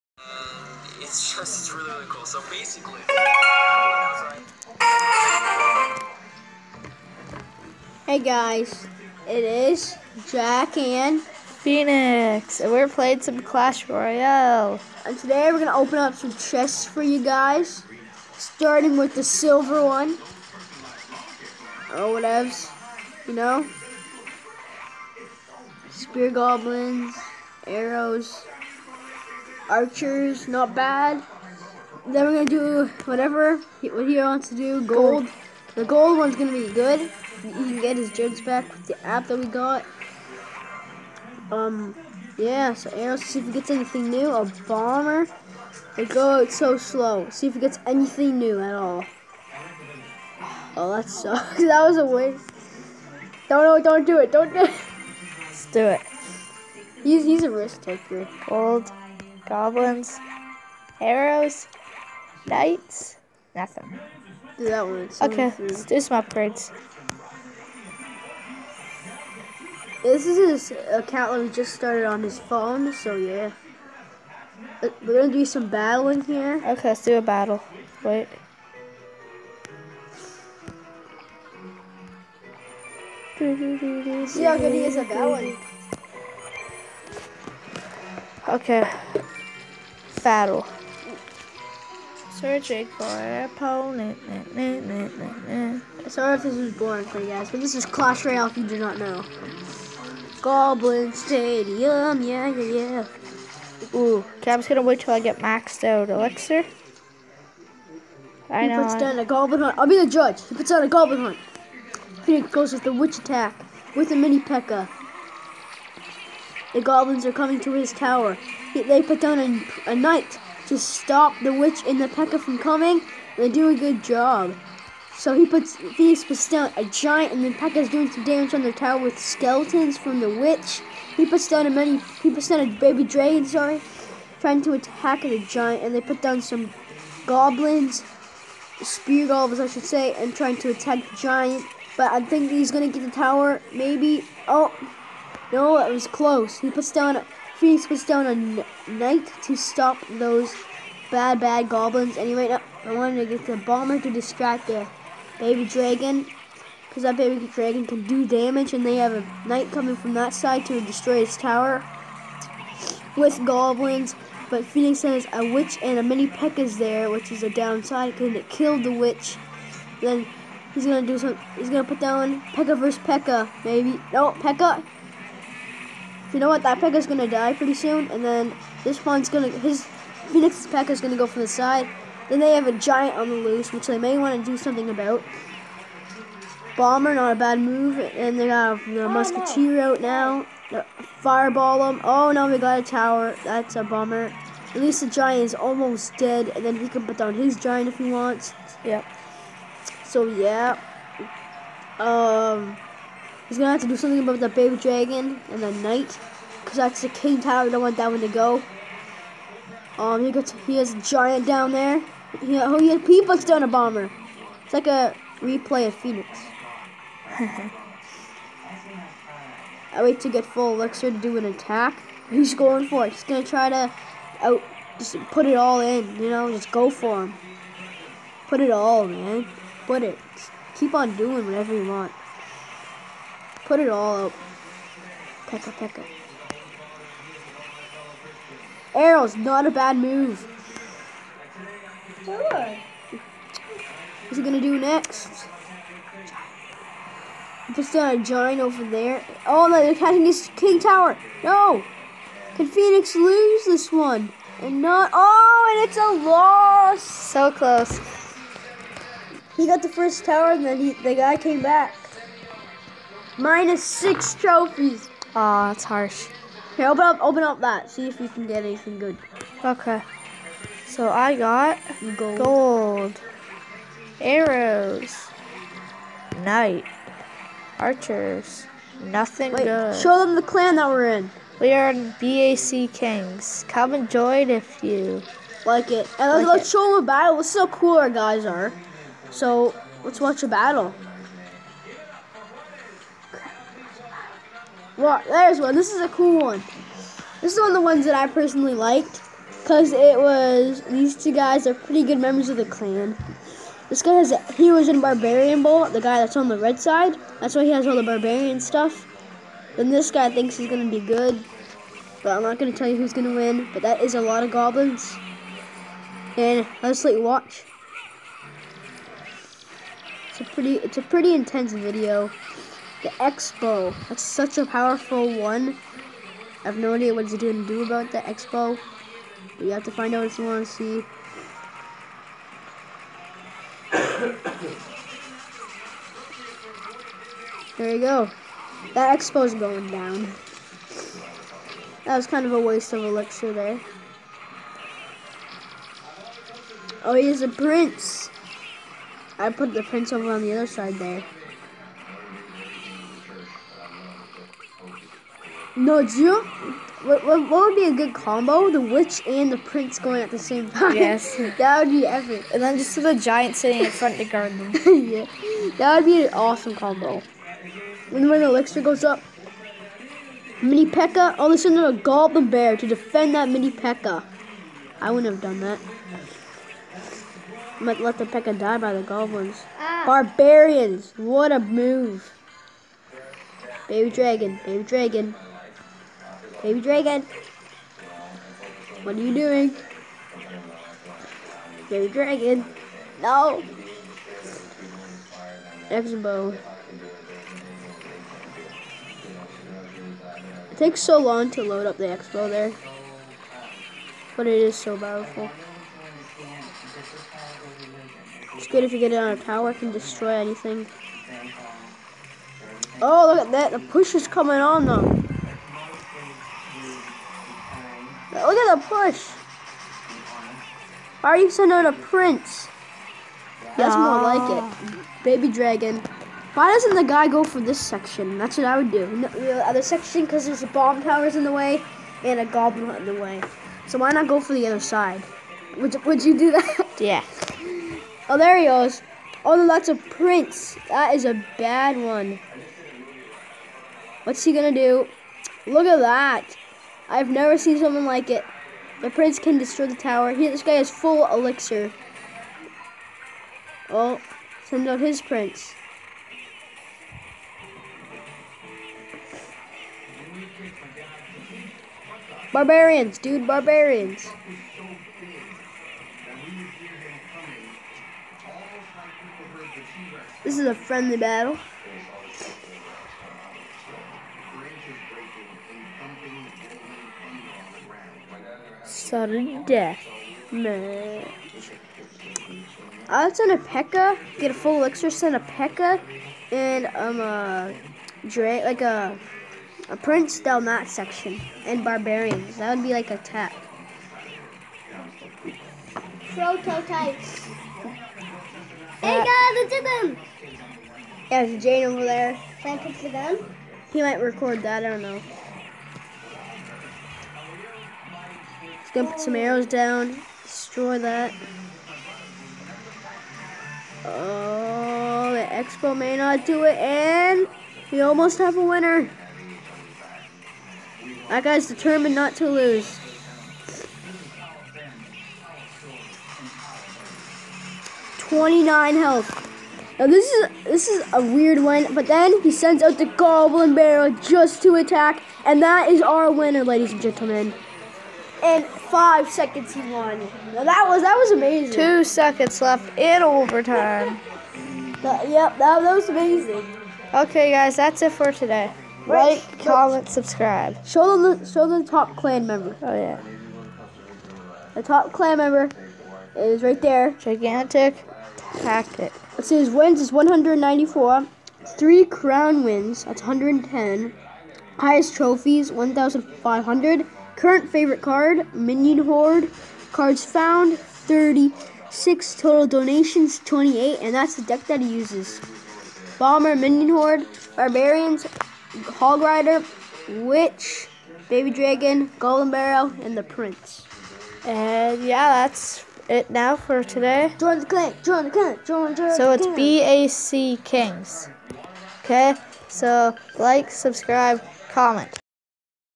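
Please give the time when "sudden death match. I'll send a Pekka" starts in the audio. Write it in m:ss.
7:59.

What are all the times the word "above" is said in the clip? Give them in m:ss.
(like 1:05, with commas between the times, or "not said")
not said.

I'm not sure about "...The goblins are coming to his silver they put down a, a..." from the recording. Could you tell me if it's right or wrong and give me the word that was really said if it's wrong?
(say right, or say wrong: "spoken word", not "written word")
wrong: "tower", not "silver".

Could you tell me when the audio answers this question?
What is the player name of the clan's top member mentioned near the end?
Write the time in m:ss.
9:17.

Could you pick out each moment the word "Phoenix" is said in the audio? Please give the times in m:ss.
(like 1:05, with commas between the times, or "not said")
0:11, 1:52, 2:27, 2:44, 3:00, 3:35, 4:12.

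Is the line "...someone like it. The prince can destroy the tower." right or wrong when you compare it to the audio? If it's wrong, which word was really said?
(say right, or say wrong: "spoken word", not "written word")
right.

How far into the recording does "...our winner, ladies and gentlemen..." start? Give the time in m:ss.
8:56.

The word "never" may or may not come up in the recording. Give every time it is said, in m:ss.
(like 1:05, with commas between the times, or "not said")
7:27.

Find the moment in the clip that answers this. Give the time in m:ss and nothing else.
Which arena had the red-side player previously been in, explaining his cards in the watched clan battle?
5:05.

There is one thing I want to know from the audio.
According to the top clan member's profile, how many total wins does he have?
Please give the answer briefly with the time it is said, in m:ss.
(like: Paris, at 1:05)
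194, at 9:19.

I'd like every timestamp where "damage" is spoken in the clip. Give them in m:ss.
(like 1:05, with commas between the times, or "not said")
2:08, 2:38.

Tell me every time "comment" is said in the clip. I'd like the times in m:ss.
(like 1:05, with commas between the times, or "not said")
9:09, 9:54.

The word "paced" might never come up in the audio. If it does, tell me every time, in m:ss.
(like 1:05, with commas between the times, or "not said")
not said.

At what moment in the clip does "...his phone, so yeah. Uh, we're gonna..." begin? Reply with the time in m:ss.
1:12.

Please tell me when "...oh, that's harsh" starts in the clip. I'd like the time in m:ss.
4:25.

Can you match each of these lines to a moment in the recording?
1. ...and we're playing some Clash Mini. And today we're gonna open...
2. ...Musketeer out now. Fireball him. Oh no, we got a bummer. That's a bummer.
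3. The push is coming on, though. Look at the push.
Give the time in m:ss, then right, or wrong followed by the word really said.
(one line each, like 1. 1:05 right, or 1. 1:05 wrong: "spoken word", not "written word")
1. 0:12 wrong: "Royale", not "Mini"
2. 3:09 wrong: "tower", not "bummer"
3. 6:53 right.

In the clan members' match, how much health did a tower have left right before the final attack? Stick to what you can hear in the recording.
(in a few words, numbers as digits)
29.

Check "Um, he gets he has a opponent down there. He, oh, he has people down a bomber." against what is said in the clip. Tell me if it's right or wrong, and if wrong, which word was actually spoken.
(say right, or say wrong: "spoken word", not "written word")
wrong: "giant", not "opponent".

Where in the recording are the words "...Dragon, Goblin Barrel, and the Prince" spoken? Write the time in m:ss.
9:41.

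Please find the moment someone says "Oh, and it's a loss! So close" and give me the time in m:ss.
4:15.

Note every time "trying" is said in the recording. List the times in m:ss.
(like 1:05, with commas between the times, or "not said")
2:14, 2:20.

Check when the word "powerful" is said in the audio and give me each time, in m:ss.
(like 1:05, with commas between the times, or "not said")
5:24, 6:44.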